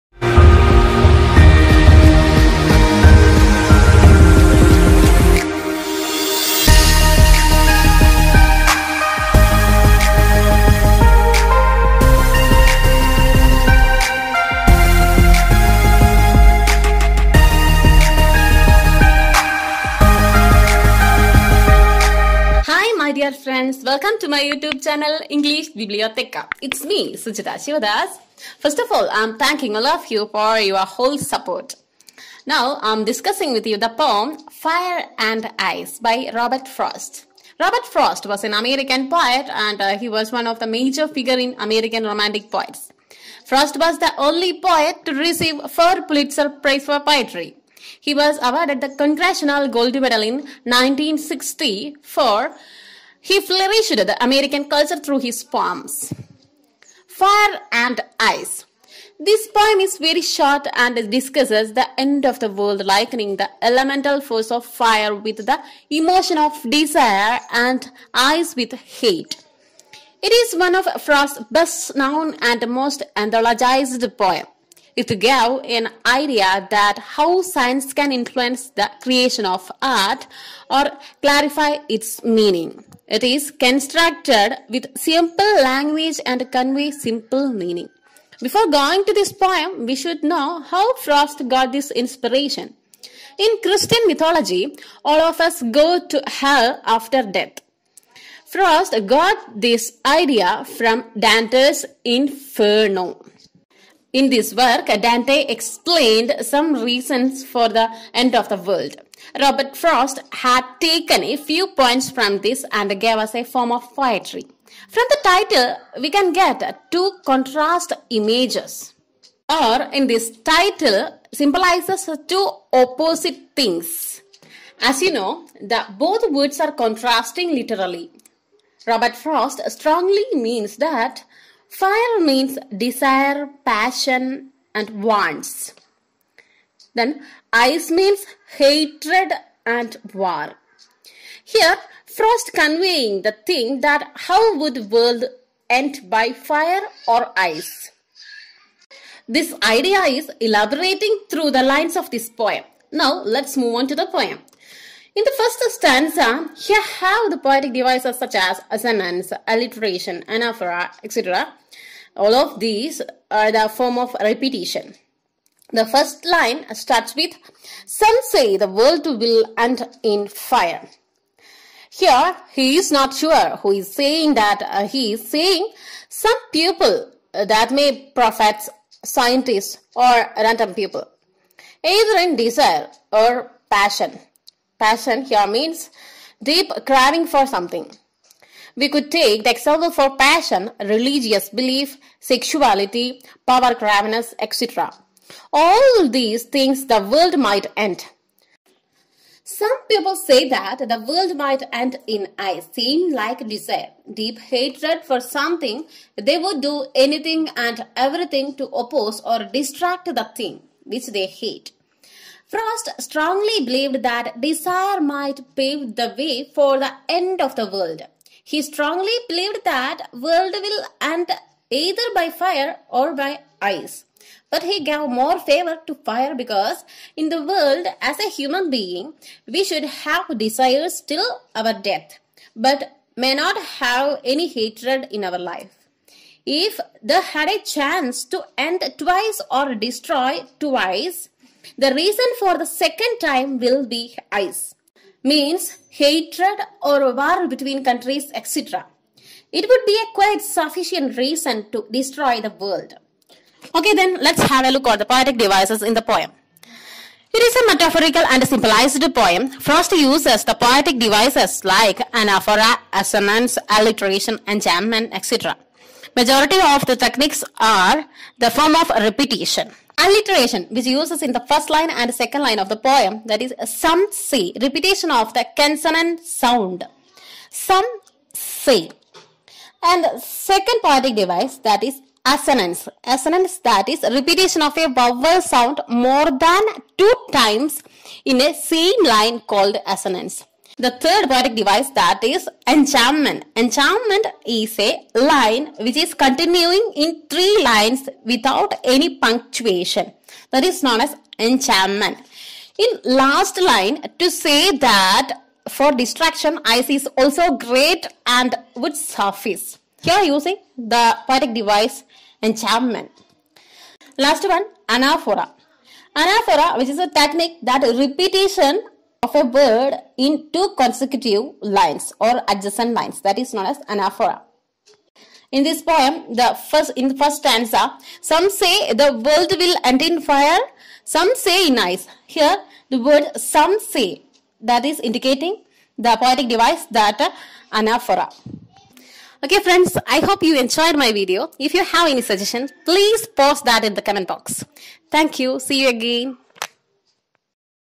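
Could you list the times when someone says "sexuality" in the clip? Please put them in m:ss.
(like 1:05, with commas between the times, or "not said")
3:12.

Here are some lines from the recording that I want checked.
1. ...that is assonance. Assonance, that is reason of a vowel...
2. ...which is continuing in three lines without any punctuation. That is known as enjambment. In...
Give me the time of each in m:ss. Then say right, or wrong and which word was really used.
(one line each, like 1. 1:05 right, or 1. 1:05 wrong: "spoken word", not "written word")
1. 4:41 wrong: "repetition", not "reason"
2. 4:55 right.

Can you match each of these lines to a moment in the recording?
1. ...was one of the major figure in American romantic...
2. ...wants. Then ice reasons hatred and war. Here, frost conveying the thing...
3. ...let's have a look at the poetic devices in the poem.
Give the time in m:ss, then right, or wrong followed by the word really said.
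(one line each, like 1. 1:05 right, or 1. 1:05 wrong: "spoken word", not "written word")
1. 0:40 right
2. 2:15 wrong: "means", not "reasons"
3. 4:14 right.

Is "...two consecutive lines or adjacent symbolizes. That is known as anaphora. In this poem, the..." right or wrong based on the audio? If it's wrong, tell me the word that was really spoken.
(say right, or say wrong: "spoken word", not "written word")
wrong: "lines", not "symbolizes".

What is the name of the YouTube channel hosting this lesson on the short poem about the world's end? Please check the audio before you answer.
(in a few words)
English Bibliotheca.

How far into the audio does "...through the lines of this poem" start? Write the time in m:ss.
2:31.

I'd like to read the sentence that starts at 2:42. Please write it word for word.
All of these are the form of repetition.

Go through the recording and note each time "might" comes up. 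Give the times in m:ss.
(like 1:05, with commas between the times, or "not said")
3:17, 3:21, 3:34.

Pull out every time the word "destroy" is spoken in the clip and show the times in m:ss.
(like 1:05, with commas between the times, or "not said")
3:59, 4:11.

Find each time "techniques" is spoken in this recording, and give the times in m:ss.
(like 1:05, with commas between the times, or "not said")
4:26, 5:17.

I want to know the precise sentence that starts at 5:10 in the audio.
Here using the poetic device enjambment.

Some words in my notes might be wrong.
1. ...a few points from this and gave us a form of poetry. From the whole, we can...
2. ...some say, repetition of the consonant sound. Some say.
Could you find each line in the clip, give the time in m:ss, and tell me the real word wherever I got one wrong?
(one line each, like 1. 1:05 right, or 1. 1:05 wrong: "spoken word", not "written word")
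1. 1:51 wrong: "title", not "whole"
2. 4:33 right.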